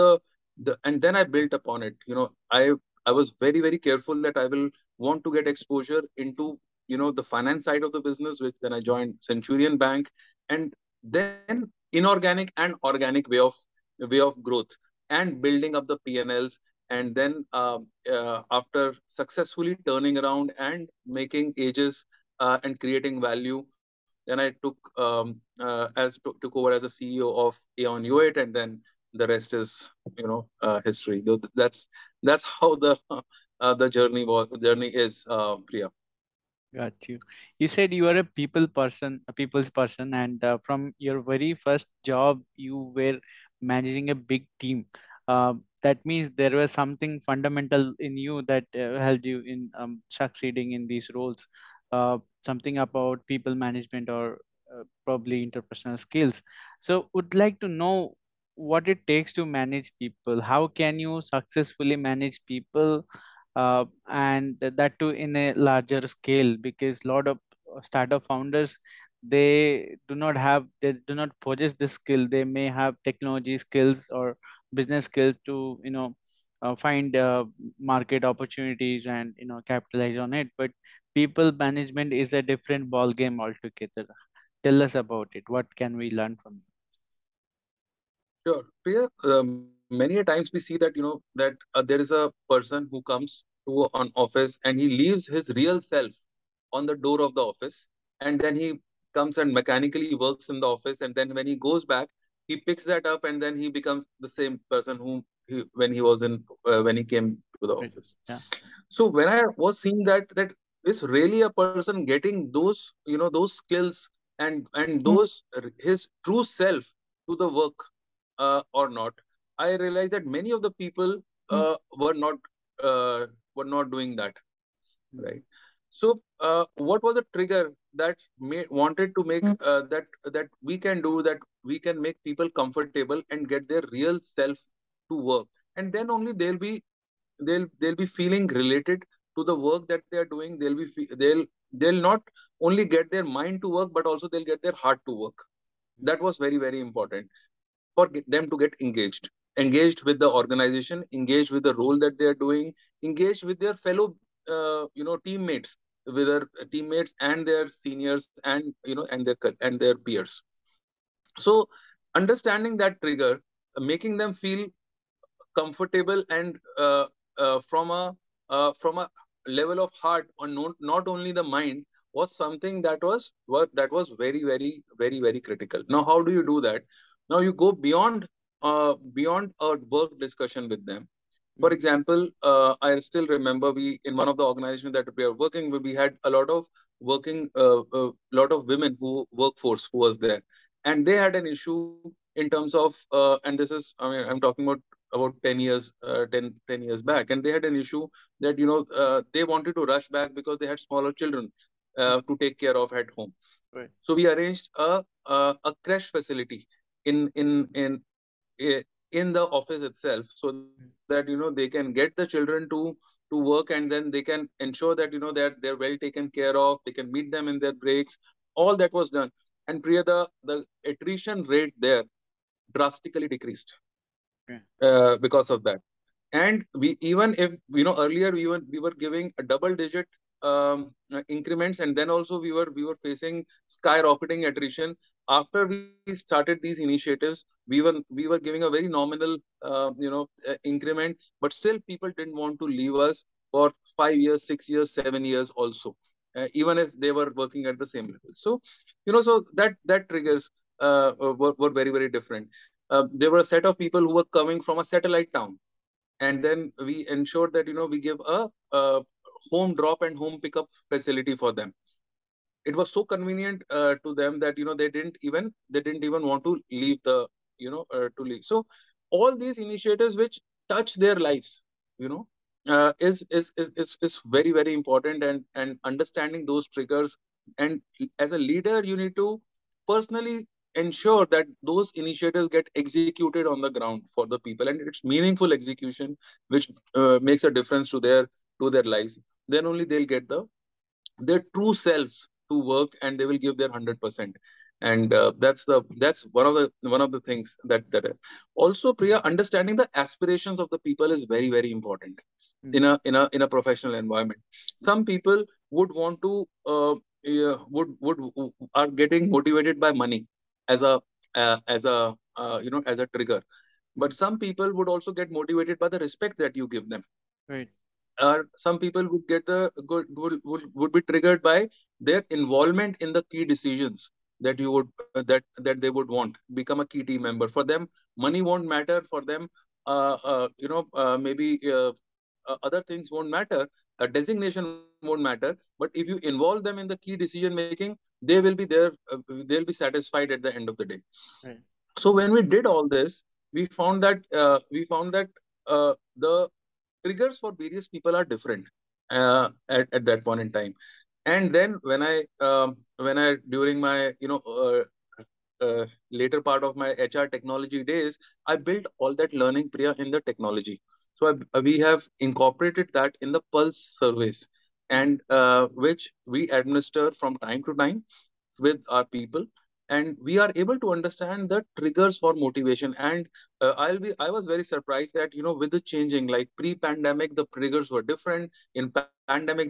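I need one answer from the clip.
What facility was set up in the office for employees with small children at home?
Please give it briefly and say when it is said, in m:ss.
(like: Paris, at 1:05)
Crèche, at 3:25.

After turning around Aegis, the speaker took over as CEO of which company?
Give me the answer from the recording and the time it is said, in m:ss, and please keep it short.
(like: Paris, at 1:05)
Aon Hewitt, at 0:27.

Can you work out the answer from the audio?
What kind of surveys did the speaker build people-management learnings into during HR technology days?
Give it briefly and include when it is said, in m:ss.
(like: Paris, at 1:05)
Pulse surveys, at 6:03.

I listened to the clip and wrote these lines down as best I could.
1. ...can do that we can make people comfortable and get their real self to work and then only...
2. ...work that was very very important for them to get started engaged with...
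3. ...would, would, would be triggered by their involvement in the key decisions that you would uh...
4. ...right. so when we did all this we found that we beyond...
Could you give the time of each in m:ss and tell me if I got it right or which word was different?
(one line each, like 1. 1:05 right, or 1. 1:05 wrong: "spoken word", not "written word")
1. 2:10 right
2. 2:25 wrong: "engaged", not "started"
3. 5:20 right
4. 5:41 wrong: "found", not "beyond".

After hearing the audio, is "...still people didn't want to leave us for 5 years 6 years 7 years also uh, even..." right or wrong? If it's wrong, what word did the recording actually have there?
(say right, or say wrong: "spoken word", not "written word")
right.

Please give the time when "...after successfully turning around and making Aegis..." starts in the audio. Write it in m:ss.
0:18.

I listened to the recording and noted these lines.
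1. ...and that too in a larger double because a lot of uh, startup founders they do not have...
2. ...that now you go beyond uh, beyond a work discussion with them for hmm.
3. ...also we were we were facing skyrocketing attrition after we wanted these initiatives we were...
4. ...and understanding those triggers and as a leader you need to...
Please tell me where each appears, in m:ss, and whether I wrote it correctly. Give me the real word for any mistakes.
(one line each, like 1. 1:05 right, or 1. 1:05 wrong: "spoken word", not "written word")
1. 1:04 wrong: "scale", not "double"
2. 2:56 right
3. 3:52 wrong: "started", not "wanted"
4. 4:35 right.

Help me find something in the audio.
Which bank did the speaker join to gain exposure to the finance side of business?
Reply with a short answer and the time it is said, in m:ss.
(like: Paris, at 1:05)
Centurion Bank, at 0:09.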